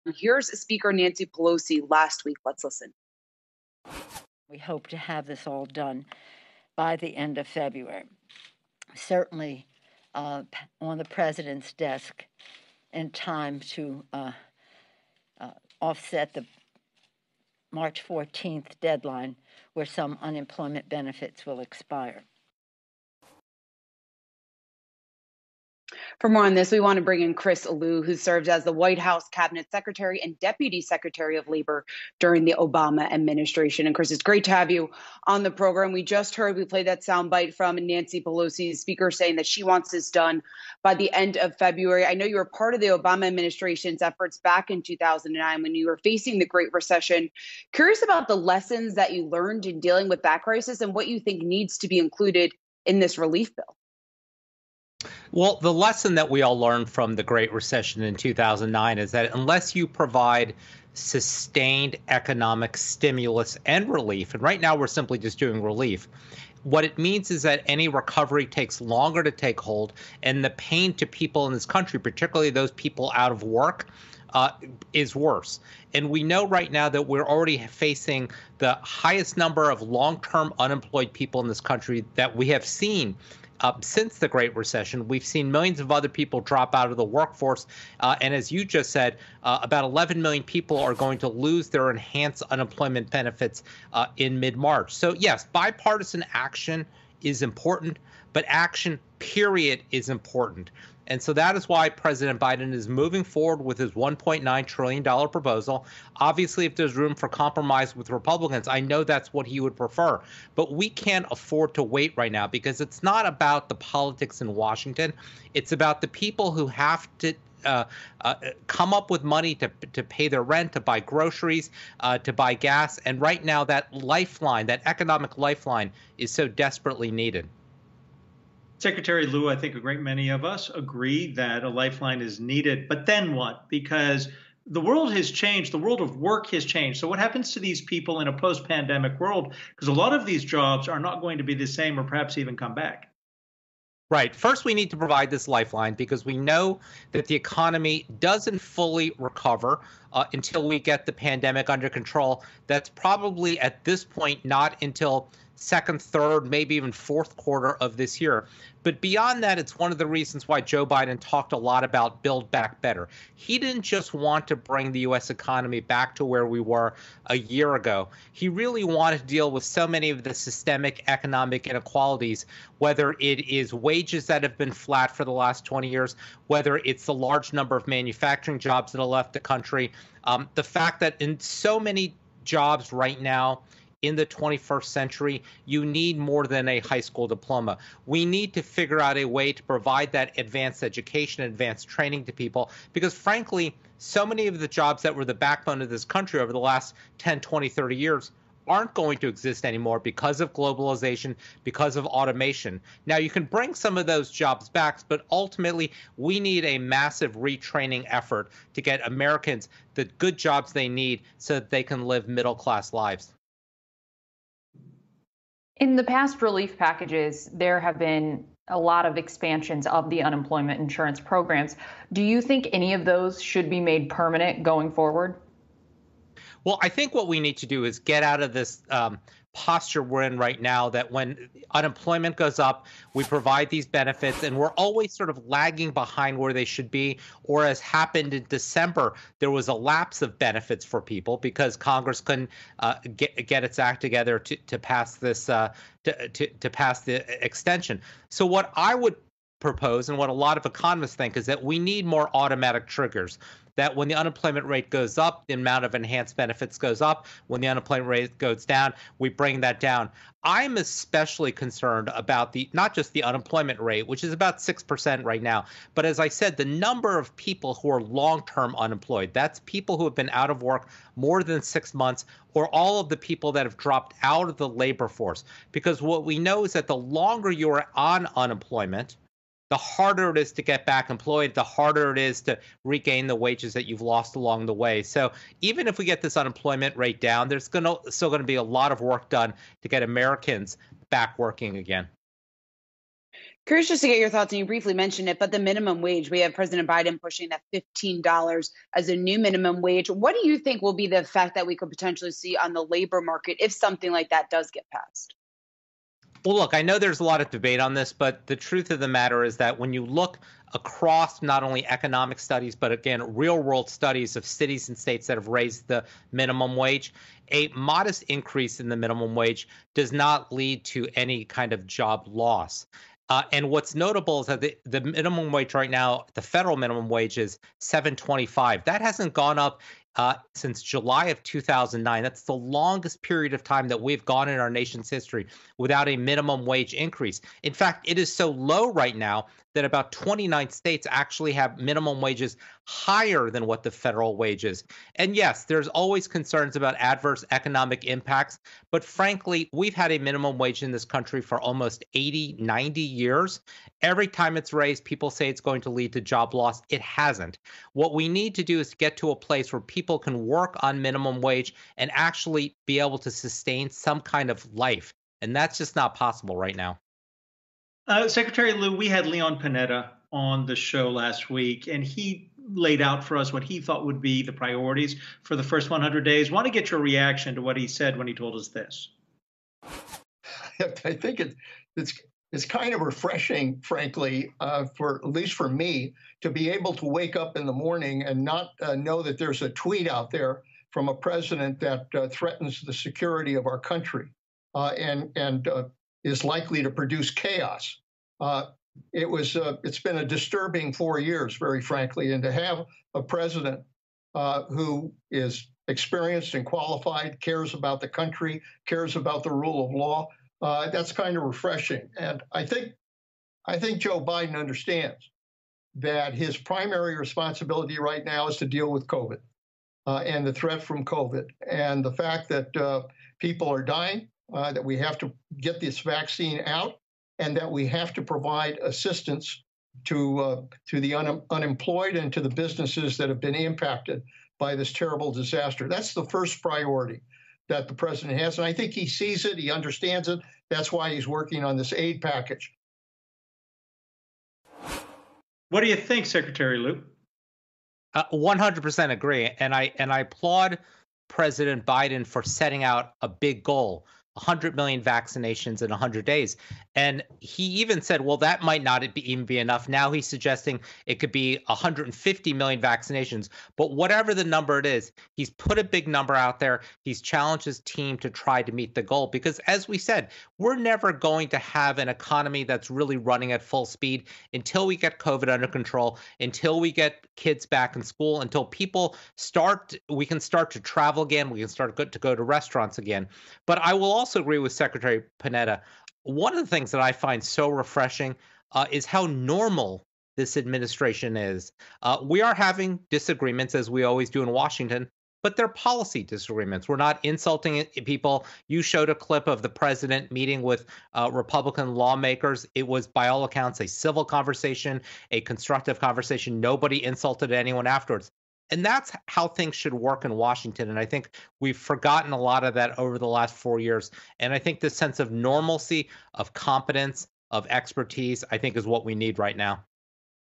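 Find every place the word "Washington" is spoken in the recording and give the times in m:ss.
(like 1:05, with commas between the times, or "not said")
1:54, 8:14, 8:30.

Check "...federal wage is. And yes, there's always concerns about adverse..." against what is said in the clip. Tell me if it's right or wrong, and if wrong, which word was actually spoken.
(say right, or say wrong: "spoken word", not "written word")
right.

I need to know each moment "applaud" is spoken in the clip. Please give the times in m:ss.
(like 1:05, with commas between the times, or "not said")
7:30.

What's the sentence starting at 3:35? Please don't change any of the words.
In the past relief packages, there have been a lot of expansions of the unemployment insurance programs.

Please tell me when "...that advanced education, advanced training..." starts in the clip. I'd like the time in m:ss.
3:10.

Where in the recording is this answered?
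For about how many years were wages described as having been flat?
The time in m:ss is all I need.
2:55.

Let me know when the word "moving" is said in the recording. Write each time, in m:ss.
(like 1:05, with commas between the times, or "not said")
1:42.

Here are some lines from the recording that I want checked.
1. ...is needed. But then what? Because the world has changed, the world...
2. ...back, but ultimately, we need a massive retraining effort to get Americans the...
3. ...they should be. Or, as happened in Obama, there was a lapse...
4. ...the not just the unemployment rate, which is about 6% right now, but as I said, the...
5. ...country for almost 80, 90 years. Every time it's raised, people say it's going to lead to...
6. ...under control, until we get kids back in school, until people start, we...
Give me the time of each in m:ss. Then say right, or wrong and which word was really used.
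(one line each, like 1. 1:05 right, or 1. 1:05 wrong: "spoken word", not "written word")
1. 2:12 right
2. 3:24 right
3. 3:56 wrong: "December", not "Obama"
4. 4:22 right
5. 5:51 right
6. 7:55 right.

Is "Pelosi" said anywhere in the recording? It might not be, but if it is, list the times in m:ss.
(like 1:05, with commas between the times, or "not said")
0:01, 0:38.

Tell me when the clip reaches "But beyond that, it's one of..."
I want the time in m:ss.
2:38.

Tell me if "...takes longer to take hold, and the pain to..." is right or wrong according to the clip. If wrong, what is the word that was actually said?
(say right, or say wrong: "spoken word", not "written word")
right.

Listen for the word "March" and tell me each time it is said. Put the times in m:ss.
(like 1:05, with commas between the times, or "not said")
0:17, 1:34.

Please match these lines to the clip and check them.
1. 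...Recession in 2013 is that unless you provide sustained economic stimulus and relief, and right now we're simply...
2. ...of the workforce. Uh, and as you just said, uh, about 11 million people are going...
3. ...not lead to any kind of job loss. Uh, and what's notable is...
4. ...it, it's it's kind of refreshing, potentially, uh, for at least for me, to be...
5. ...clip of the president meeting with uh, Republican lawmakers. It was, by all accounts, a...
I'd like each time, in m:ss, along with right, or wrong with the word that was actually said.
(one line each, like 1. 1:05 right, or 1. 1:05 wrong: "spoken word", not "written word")
1. 0:57 wrong: "2009", not "2013"
2. 1:26 right
3. 5:20 right
4. 6:21 wrong: "frankly", not "potentially"
5. 8:19 right.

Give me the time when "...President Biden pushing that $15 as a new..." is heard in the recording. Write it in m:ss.
4:56.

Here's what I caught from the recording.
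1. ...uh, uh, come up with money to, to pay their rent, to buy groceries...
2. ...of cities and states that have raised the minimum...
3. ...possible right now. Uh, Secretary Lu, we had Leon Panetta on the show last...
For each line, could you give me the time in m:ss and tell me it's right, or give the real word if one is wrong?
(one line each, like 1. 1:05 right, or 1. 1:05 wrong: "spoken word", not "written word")
1. 1:57 right
2. 5:14 right
3. 6:06 right.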